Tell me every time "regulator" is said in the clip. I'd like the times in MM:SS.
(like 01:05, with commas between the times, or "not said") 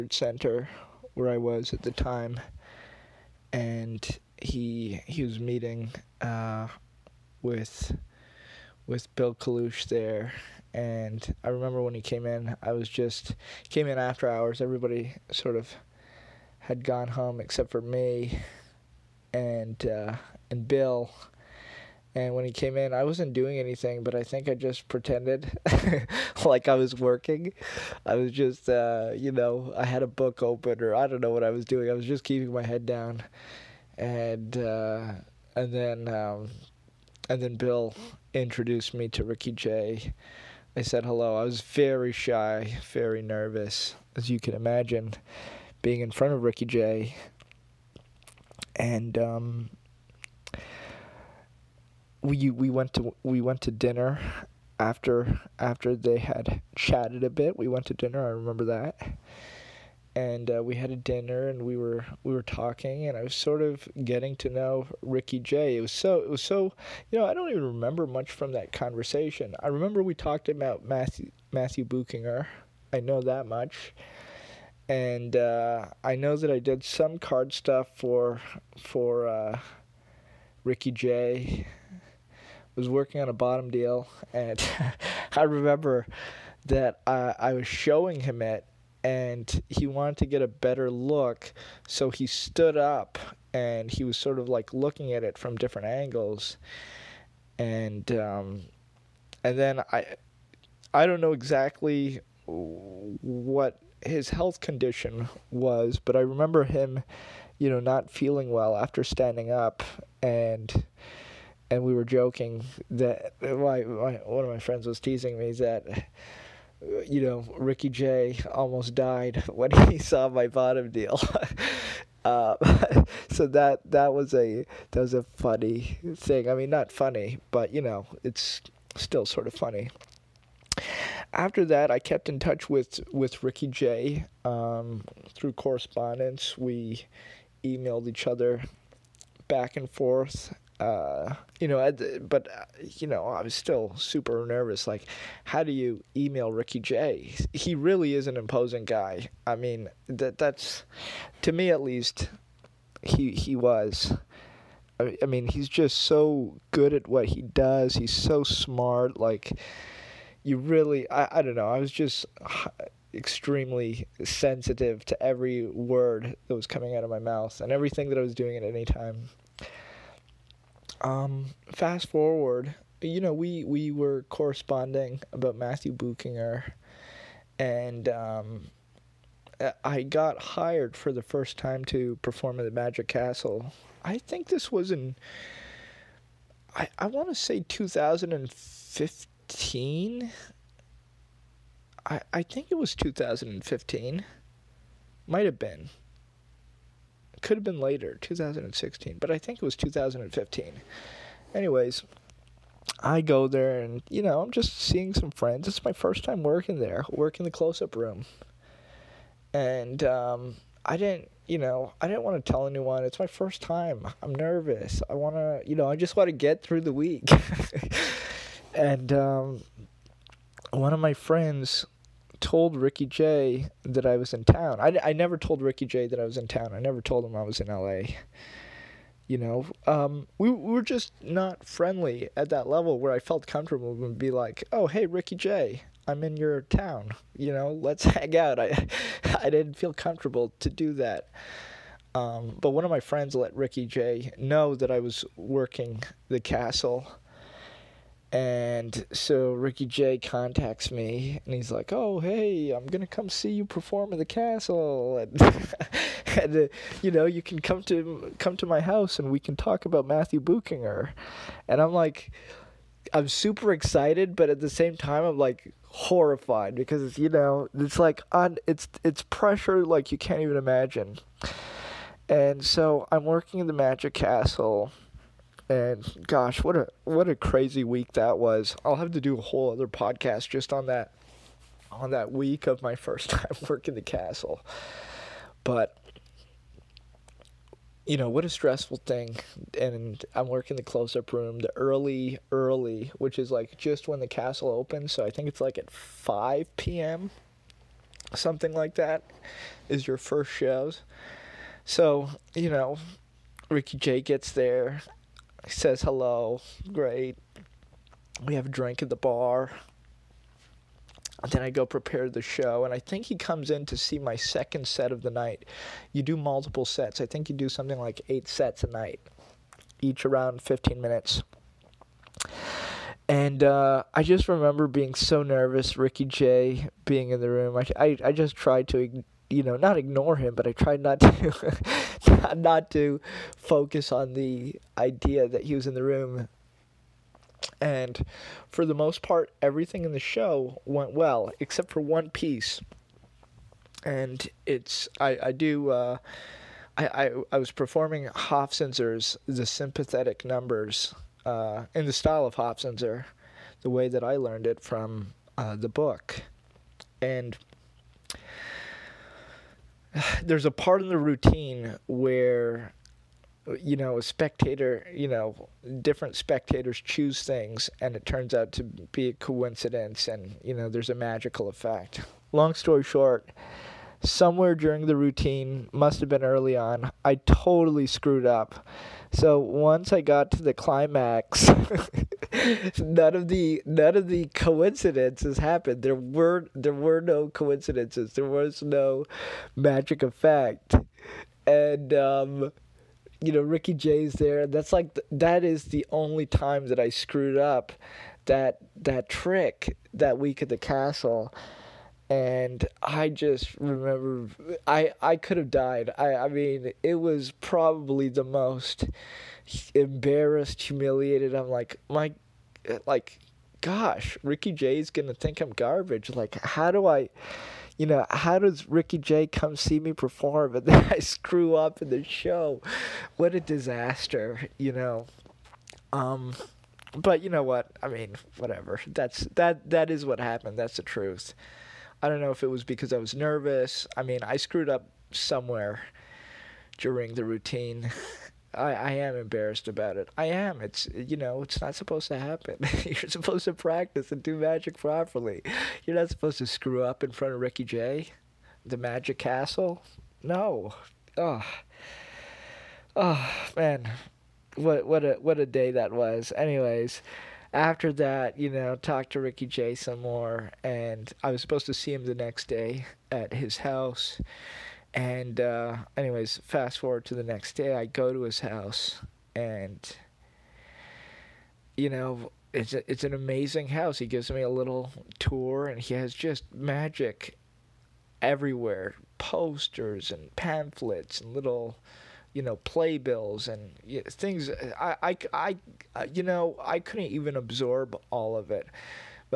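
not said.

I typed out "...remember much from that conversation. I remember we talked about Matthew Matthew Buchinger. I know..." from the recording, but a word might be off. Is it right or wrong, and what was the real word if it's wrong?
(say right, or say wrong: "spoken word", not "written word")
right.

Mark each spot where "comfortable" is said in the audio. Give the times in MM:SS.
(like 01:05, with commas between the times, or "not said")
03:53, 03:59.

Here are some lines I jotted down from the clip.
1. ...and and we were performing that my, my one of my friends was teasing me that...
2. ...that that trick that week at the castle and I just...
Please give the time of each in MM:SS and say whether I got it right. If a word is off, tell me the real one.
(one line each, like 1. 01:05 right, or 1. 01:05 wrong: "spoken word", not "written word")
1. 01:50 wrong: "joking", not "performing"
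2. 06:38 right.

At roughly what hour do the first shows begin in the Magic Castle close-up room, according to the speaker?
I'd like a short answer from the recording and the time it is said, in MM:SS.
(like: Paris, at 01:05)
5 p.m., at 04:55.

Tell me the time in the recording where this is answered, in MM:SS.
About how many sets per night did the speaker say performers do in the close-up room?
05:18.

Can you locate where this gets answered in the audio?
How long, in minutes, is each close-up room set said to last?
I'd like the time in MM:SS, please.
05:20.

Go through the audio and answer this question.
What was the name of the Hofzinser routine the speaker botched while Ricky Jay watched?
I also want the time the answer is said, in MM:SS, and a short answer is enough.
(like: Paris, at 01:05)
The Sympathetic Numbers, at 05:49.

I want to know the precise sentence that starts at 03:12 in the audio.
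I, I think it was 2015.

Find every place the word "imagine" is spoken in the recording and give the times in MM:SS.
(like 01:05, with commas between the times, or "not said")
00:44, 04:30.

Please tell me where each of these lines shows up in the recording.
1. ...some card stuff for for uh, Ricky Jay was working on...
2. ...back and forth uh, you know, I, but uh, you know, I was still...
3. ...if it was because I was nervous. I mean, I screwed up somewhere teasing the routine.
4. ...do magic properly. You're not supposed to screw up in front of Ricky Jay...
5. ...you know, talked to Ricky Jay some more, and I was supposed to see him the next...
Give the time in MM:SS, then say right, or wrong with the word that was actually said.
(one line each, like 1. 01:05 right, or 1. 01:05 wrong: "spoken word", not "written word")
1. 01:16 right
2. 02:19 right
3. 07:12 wrong: "during", not "teasing"
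4. 07:24 right
5. 07:38 right.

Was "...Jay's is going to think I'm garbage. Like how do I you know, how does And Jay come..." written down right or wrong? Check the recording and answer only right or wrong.
wrong.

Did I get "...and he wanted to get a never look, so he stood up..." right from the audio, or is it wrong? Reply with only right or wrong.
wrong.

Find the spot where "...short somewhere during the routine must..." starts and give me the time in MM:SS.
06:13.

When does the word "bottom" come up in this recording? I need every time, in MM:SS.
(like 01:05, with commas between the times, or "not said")
01:23, 02:00.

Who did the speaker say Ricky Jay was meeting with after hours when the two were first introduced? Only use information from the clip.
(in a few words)
Bill Kalush.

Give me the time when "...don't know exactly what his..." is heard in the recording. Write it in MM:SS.
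01:41.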